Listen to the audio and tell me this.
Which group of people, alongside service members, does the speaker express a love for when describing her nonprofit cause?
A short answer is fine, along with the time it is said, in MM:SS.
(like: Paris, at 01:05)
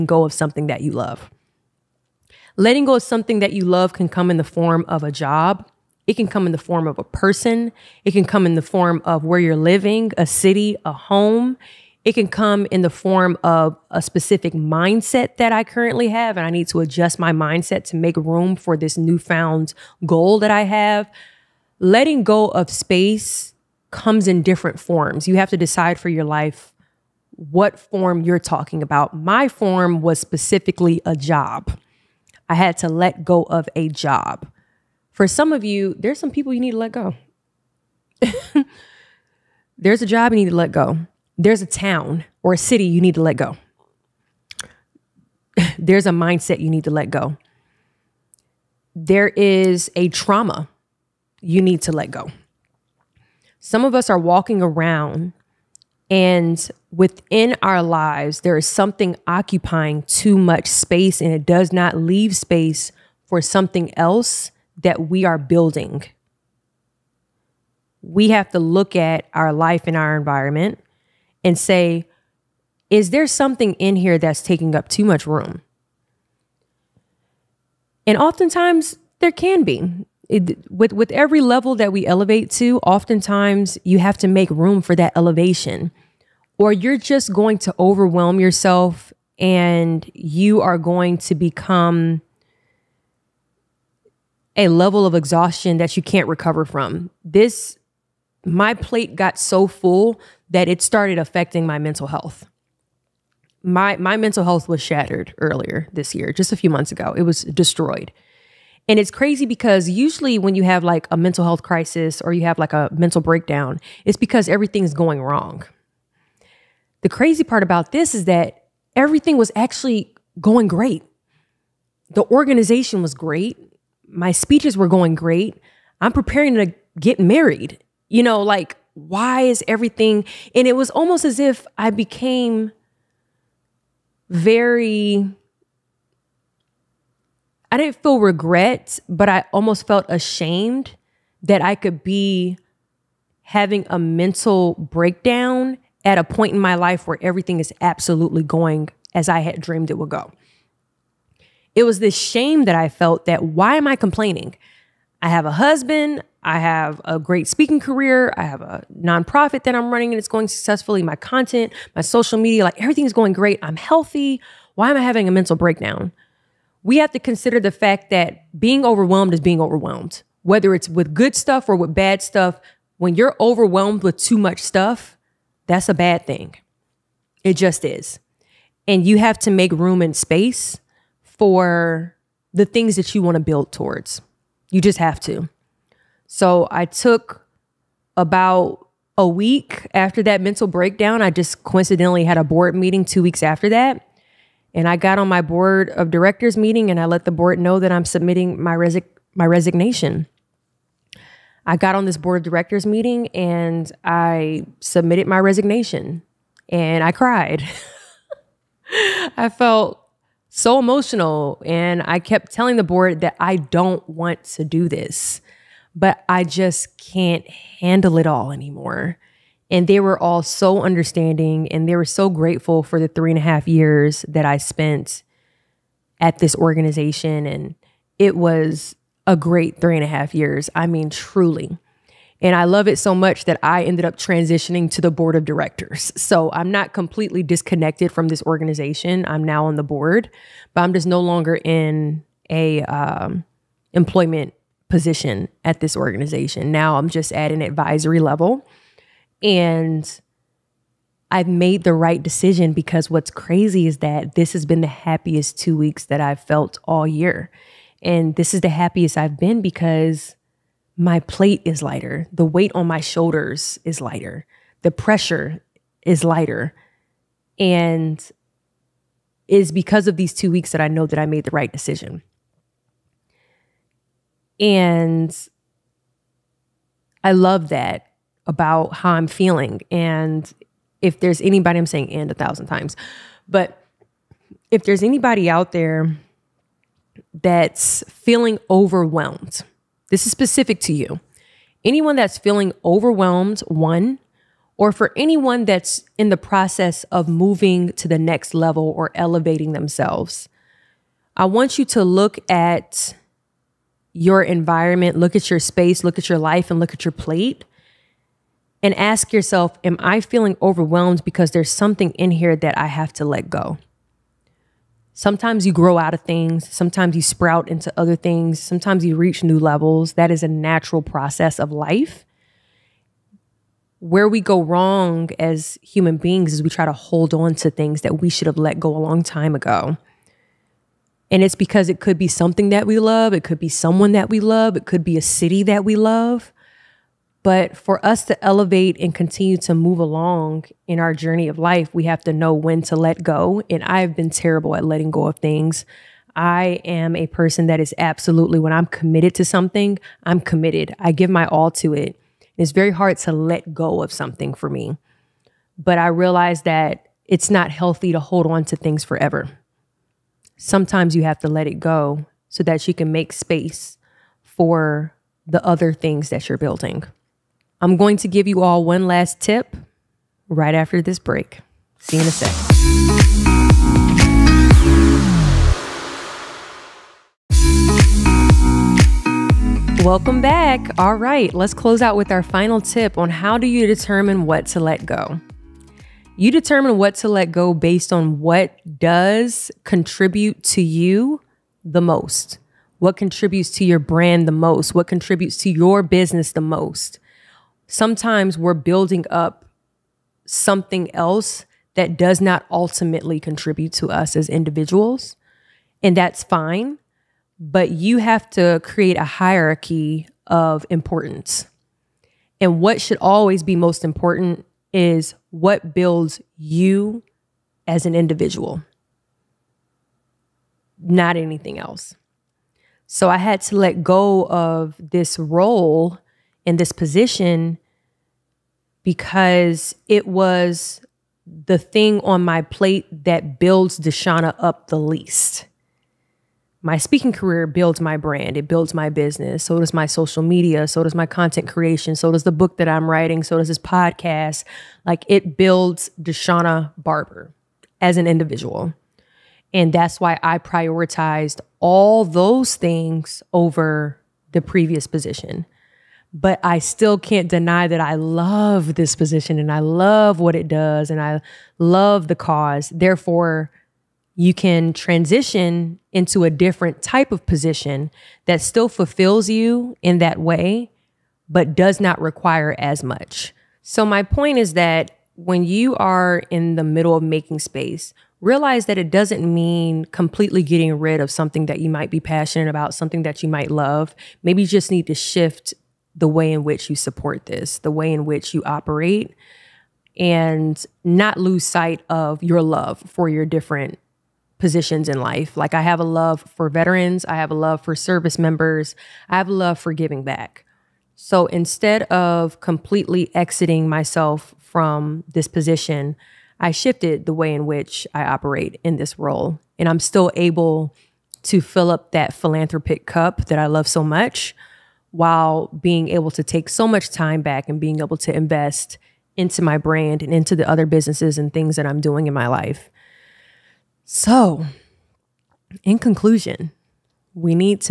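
Veterans, at 08:16.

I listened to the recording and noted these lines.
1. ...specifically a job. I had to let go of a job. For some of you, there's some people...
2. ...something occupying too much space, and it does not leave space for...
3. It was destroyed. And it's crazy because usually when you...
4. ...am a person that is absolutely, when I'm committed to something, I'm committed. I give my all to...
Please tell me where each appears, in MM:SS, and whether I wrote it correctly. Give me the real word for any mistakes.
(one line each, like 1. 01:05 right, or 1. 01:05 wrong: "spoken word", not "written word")
1. 00:30 right
2. 00:58 right
3. 01:47 right
4. 05:46 right.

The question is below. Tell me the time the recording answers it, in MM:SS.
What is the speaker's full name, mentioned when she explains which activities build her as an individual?
07:26.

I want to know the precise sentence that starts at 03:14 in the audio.
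And I got on my board of directors meeting and I let the board know that I'm submitting my, resi- my resignation.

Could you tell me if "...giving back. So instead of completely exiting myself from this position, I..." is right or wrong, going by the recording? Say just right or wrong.
right.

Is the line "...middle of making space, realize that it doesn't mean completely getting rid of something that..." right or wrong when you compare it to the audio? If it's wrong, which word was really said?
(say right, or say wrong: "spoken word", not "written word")
right.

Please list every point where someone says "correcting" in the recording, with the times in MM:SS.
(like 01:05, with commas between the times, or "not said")
not said.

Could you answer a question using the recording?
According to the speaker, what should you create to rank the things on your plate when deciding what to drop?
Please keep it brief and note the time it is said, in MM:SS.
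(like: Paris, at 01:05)
A hierarchy of importance, at 06:49.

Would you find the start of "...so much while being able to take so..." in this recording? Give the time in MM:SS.
08:33.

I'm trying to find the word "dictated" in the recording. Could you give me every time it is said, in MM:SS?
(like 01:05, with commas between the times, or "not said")
not said.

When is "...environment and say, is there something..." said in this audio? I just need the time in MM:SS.
01:10.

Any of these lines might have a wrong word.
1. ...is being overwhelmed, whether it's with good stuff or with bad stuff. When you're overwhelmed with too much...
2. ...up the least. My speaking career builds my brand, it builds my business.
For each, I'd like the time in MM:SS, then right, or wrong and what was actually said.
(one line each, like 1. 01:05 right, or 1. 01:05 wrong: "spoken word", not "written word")
1. 02:49 right
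2. 07:14 right.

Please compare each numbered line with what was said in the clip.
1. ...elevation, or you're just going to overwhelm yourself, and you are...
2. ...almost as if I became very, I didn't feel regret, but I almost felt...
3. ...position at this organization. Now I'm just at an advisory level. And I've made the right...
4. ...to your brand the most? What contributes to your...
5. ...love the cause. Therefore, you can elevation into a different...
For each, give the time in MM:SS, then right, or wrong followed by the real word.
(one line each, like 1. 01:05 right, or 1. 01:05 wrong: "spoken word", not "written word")
1. 01:25 right
2. 02:10 right
3. 04:04 right
4. 06:33 right
5. 07:41 wrong: "transition", not "elevation".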